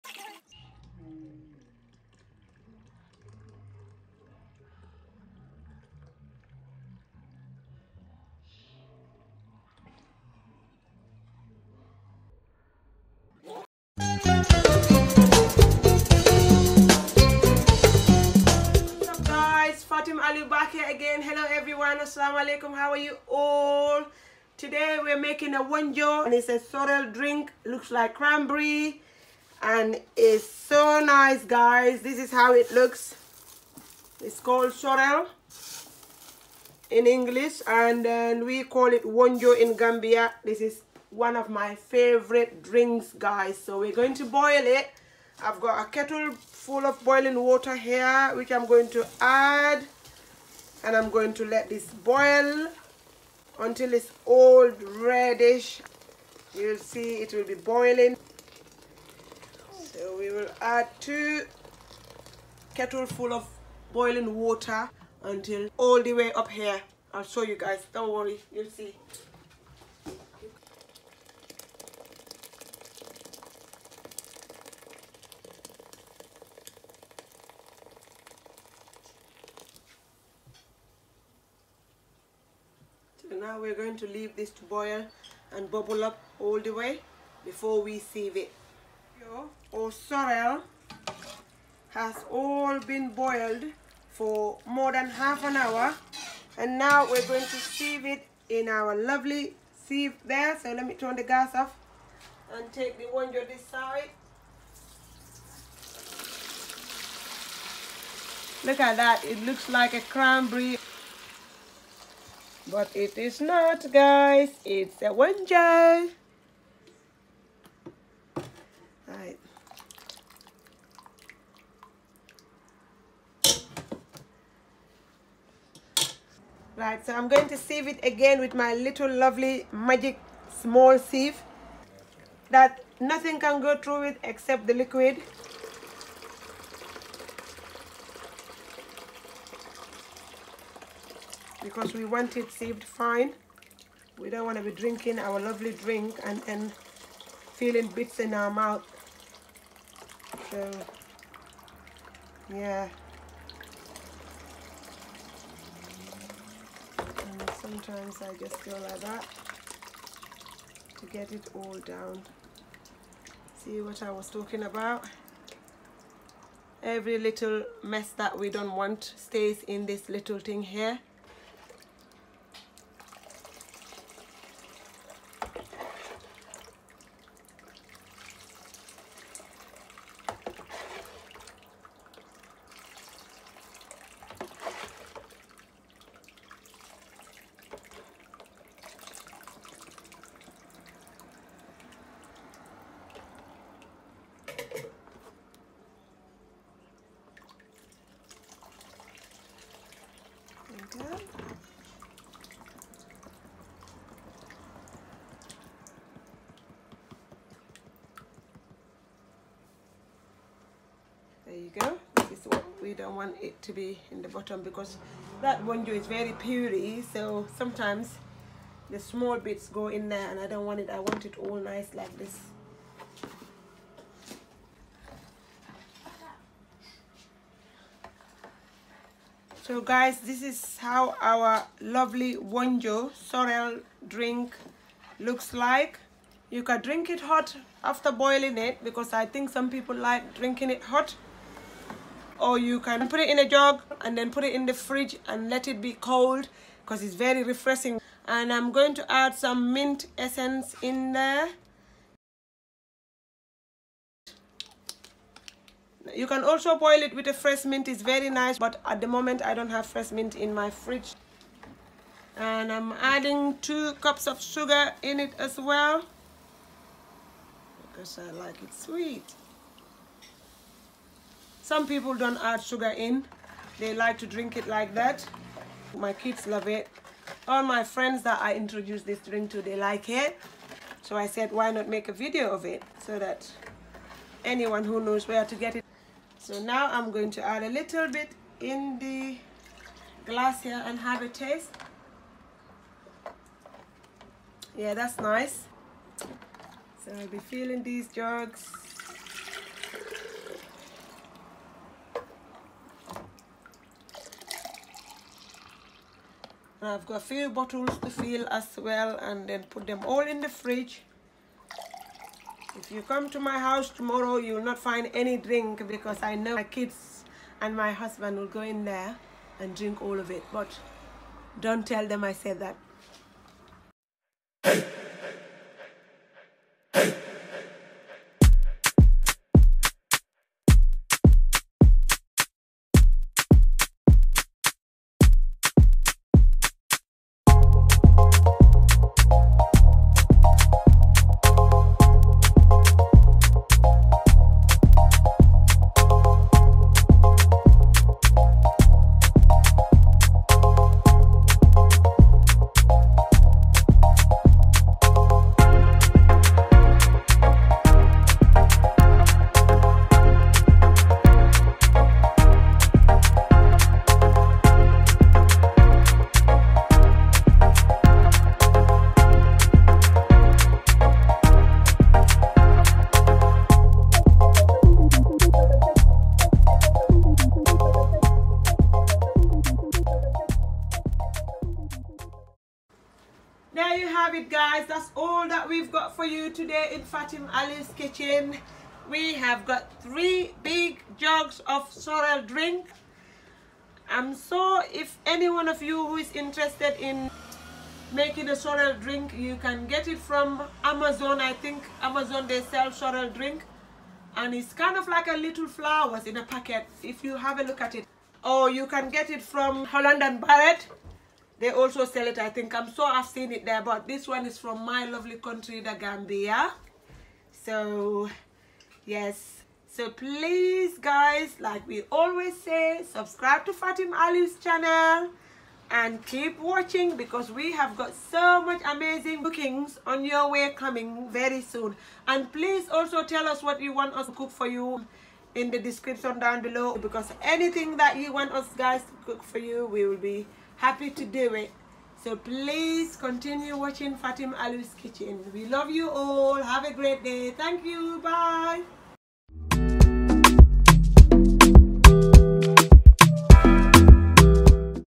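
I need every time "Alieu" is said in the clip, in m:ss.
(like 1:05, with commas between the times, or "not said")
6:27, 7:04, 7:24.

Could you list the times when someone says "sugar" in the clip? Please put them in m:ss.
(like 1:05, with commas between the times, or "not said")
4:24, 4:32.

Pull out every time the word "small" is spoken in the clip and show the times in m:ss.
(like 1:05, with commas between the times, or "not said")
2:10, 3:38.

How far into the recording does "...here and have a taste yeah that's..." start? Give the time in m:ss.
4:50.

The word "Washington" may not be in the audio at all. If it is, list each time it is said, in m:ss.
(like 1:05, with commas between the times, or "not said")
not said.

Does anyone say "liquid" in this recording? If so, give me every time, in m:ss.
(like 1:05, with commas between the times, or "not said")
2:14.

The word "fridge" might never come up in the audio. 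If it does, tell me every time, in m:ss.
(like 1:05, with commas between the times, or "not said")
4:04, 4:20, 5:10.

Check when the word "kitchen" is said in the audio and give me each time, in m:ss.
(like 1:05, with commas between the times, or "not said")
6:27, 7:25.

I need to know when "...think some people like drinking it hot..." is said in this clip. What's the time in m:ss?
3:59.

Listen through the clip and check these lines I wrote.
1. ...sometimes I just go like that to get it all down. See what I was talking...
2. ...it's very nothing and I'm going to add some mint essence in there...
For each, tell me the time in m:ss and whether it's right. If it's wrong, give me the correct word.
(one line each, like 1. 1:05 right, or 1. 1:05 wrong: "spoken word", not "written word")
1. 2:37 right
2. 4:07 wrong: "refreshing", not "nothing".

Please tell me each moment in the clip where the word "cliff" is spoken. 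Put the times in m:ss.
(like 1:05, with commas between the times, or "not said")
not said.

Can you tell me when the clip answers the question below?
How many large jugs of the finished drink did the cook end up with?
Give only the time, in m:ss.
6:30.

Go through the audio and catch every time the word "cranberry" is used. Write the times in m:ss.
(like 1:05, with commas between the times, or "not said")
0:28, 1:50.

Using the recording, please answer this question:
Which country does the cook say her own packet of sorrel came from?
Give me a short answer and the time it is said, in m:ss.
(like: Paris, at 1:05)
The Gambia, at 6:55.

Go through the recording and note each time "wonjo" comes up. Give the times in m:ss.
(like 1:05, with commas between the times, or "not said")
0:25, 0:39, 1:55, 3:35, 3:52.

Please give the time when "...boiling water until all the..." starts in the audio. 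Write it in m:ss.
1:03.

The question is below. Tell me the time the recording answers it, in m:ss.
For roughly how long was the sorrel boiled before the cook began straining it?
1:34.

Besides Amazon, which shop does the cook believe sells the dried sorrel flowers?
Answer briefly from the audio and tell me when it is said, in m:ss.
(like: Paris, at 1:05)
Holland and Barrett, at 6:49.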